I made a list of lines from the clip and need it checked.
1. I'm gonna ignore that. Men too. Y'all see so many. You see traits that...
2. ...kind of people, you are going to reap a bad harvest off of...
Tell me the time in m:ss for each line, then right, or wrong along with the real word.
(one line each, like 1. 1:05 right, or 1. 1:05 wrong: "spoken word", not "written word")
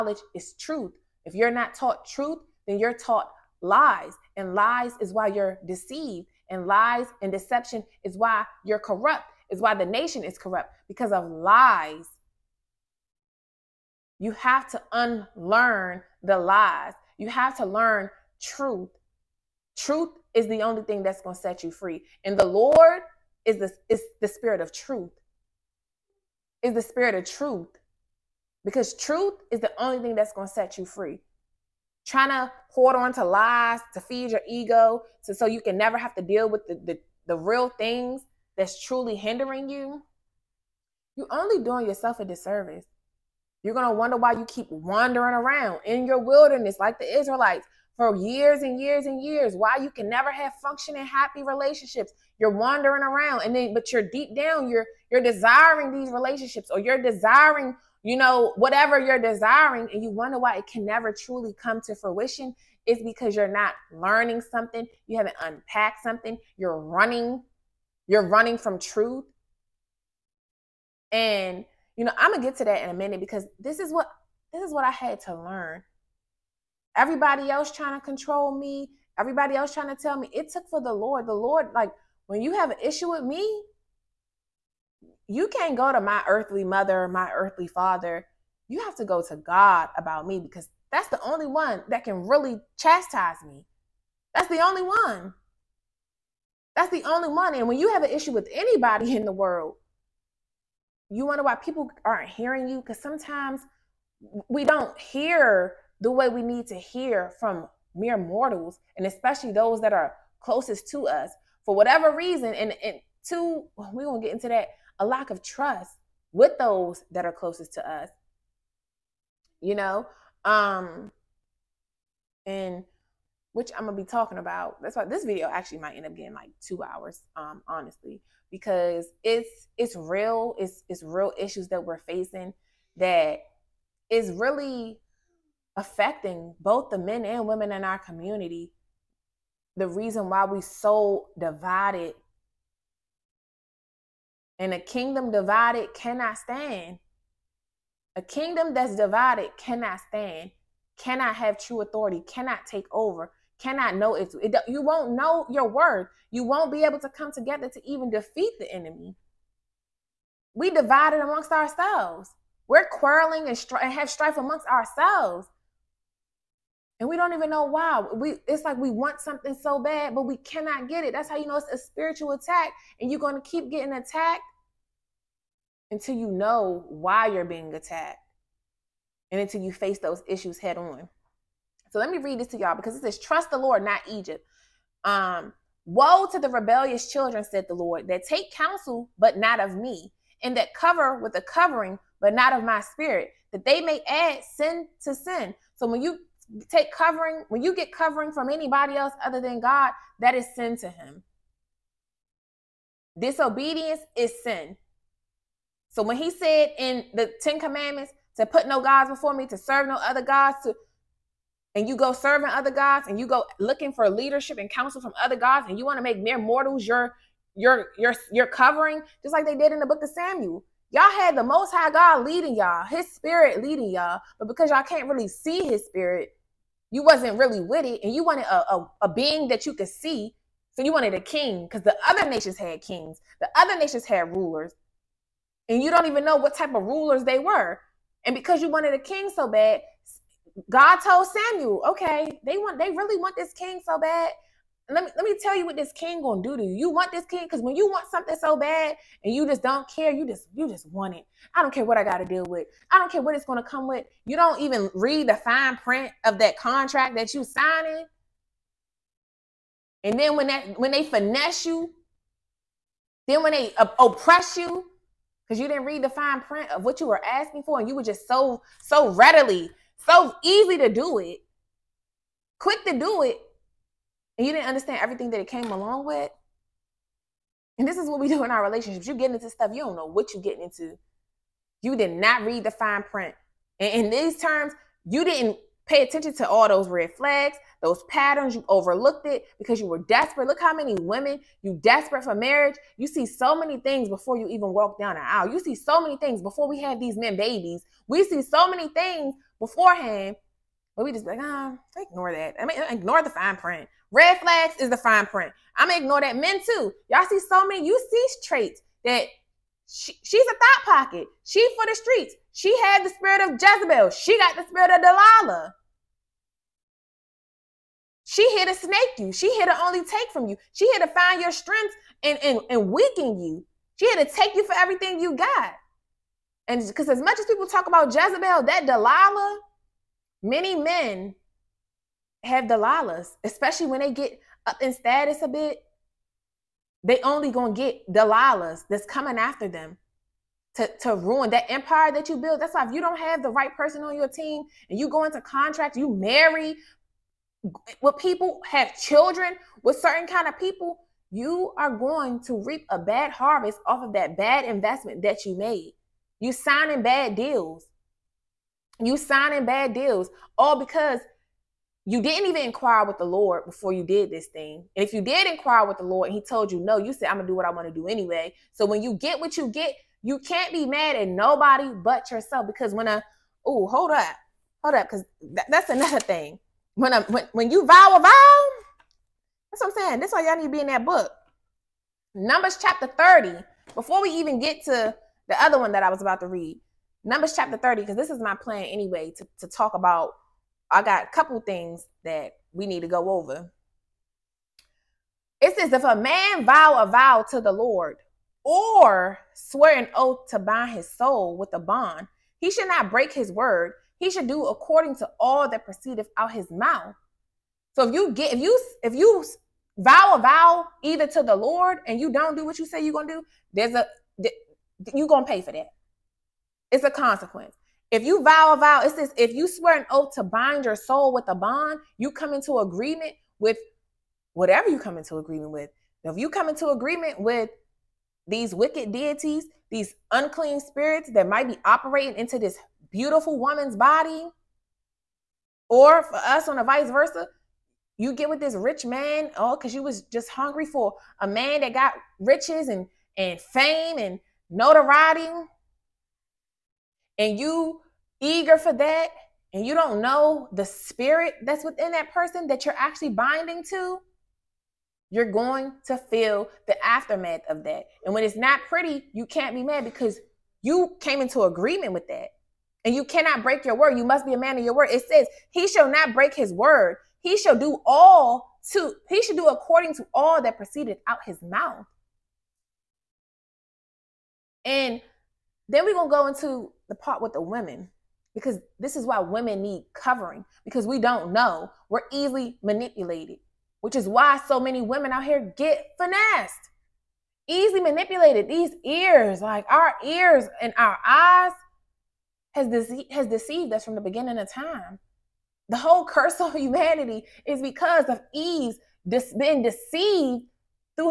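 1. 5:05 right
2. 5:50 right.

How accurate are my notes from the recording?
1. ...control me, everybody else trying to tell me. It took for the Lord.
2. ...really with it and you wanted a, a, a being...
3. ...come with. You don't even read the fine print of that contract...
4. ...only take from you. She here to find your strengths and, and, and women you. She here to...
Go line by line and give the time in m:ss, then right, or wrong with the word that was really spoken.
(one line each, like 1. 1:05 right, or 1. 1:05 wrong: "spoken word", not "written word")
1. 1:18 right
2. 3:47 right
3. 4:13 right
4. 5:19 wrong: "weaken", not "women".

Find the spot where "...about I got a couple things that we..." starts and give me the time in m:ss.
6:29.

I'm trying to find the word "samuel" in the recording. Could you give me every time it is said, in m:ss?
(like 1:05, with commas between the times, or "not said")
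3:40, 4:01.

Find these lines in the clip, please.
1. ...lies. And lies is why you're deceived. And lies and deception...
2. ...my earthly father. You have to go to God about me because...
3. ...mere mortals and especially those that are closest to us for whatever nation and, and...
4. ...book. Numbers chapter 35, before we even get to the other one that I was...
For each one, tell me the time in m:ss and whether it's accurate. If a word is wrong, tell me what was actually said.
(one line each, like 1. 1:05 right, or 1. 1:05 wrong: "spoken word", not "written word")
1. 0:03 right
2. 1:27 right
3. 1:47 wrong: "reason", not "nation"
4. 6:21 wrong: "30", not "35".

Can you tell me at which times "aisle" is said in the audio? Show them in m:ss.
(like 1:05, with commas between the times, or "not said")
4:55.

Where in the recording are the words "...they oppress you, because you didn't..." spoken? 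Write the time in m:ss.
4:23.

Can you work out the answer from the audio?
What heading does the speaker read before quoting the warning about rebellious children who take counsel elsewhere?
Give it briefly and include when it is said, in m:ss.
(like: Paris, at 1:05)
Trust the Lord not Egypt, at 3:03.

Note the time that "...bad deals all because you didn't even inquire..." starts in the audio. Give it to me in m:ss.
5:59.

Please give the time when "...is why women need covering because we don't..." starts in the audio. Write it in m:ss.
7:59.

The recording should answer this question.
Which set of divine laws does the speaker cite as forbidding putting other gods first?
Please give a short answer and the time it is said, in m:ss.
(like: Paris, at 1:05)
The 10 commandments, at 3:27.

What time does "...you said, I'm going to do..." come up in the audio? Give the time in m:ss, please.
6:06.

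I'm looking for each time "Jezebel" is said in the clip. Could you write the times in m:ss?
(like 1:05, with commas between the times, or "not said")
5:13, 5:28.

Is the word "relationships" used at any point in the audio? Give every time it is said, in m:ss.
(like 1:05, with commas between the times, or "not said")
0:51, 0:56, 4:38.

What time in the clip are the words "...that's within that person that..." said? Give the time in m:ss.
7:31.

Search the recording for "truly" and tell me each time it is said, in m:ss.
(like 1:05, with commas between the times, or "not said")
0:38, 1:01.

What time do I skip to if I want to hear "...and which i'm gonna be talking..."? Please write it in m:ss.
2:02.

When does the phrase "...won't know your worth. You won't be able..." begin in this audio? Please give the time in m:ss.
2:34.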